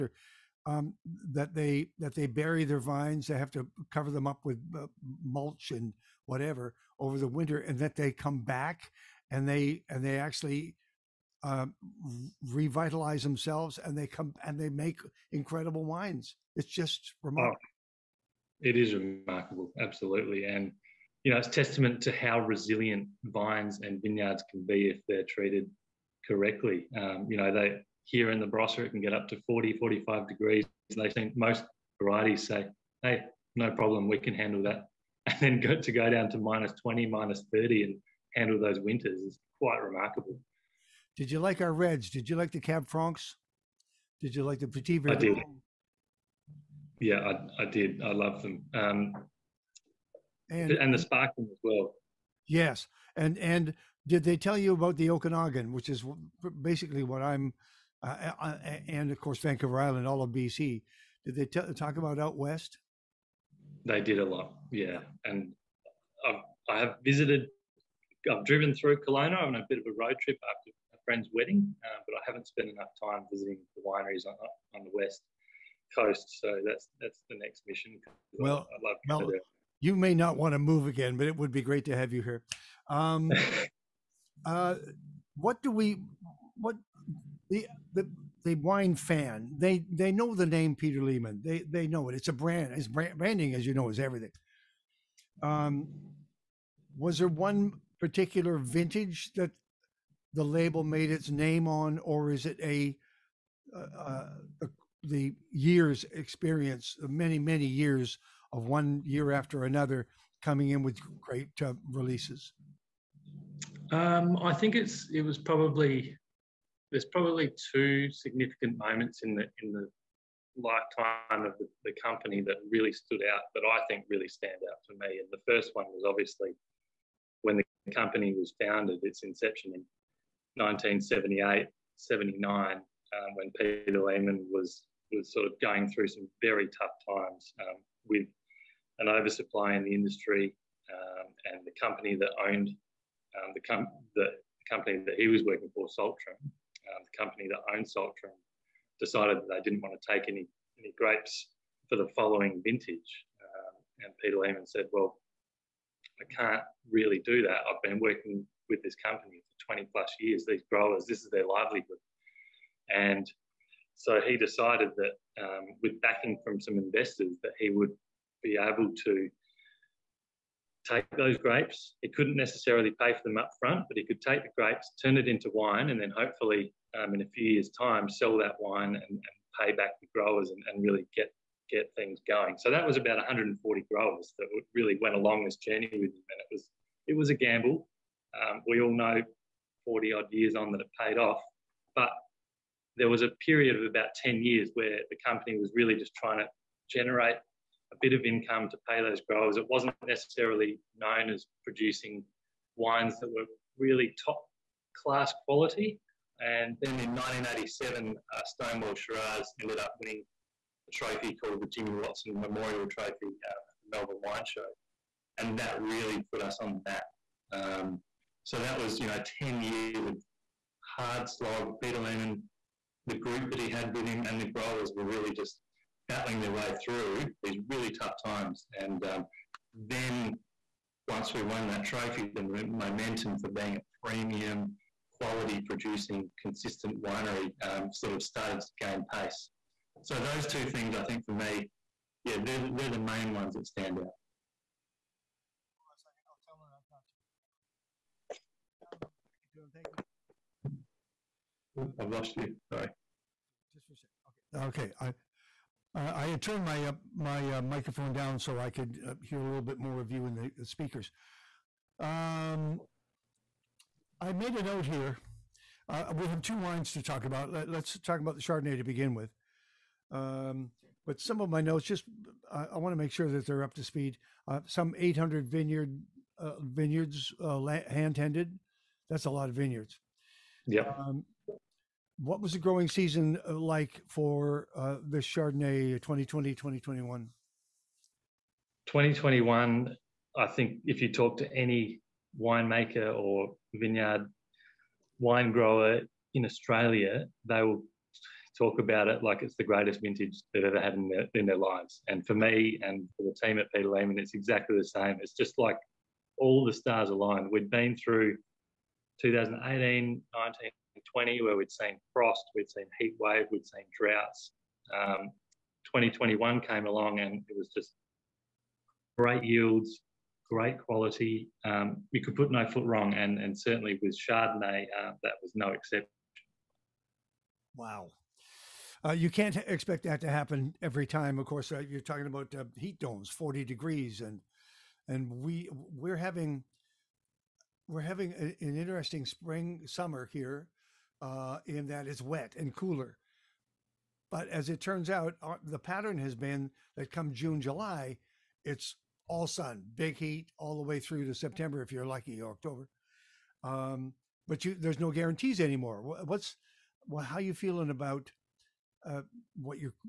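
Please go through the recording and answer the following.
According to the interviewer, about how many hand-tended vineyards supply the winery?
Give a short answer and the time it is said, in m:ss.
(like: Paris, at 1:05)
800, at 4:34.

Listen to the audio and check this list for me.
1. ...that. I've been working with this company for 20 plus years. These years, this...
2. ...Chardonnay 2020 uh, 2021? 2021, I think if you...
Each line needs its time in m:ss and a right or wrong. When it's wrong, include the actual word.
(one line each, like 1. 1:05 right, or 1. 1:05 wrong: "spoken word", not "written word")
1. 2:37 wrong: "growers", not "years"
2. 4:45 right.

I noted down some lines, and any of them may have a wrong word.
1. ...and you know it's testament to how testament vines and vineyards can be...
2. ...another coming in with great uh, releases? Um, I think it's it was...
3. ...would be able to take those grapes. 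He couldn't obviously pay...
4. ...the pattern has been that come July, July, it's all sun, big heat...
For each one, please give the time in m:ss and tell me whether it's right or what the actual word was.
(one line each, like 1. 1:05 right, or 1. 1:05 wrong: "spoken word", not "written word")
1. 0:20 wrong: "resilient", not "testament"
2. 1:49 right
3. 2:47 wrong: "necessarily", not "obviously"
4. 5:45 wrong: "June", not "July".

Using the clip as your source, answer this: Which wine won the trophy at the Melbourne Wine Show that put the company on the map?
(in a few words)
Stonewell Shiraz.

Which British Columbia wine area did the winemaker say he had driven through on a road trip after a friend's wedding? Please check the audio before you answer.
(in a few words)
Kelowna.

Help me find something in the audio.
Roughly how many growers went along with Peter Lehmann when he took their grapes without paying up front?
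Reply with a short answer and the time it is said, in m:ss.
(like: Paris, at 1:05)
140, at 3:03.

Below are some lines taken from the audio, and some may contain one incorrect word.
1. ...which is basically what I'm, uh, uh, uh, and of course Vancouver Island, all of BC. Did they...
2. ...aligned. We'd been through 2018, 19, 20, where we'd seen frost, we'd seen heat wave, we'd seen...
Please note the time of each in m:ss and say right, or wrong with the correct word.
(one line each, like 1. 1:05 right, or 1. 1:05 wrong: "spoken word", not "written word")
1. 0:55 right
2. 5:07 right.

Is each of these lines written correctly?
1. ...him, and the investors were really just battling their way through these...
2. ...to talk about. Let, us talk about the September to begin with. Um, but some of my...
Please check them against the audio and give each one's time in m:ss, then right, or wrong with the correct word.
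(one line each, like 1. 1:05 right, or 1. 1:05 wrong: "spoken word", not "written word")
1. 3:44 wrong: "growers", not "investors"
2. 4:26 wrong: "Chardonnay", not "September".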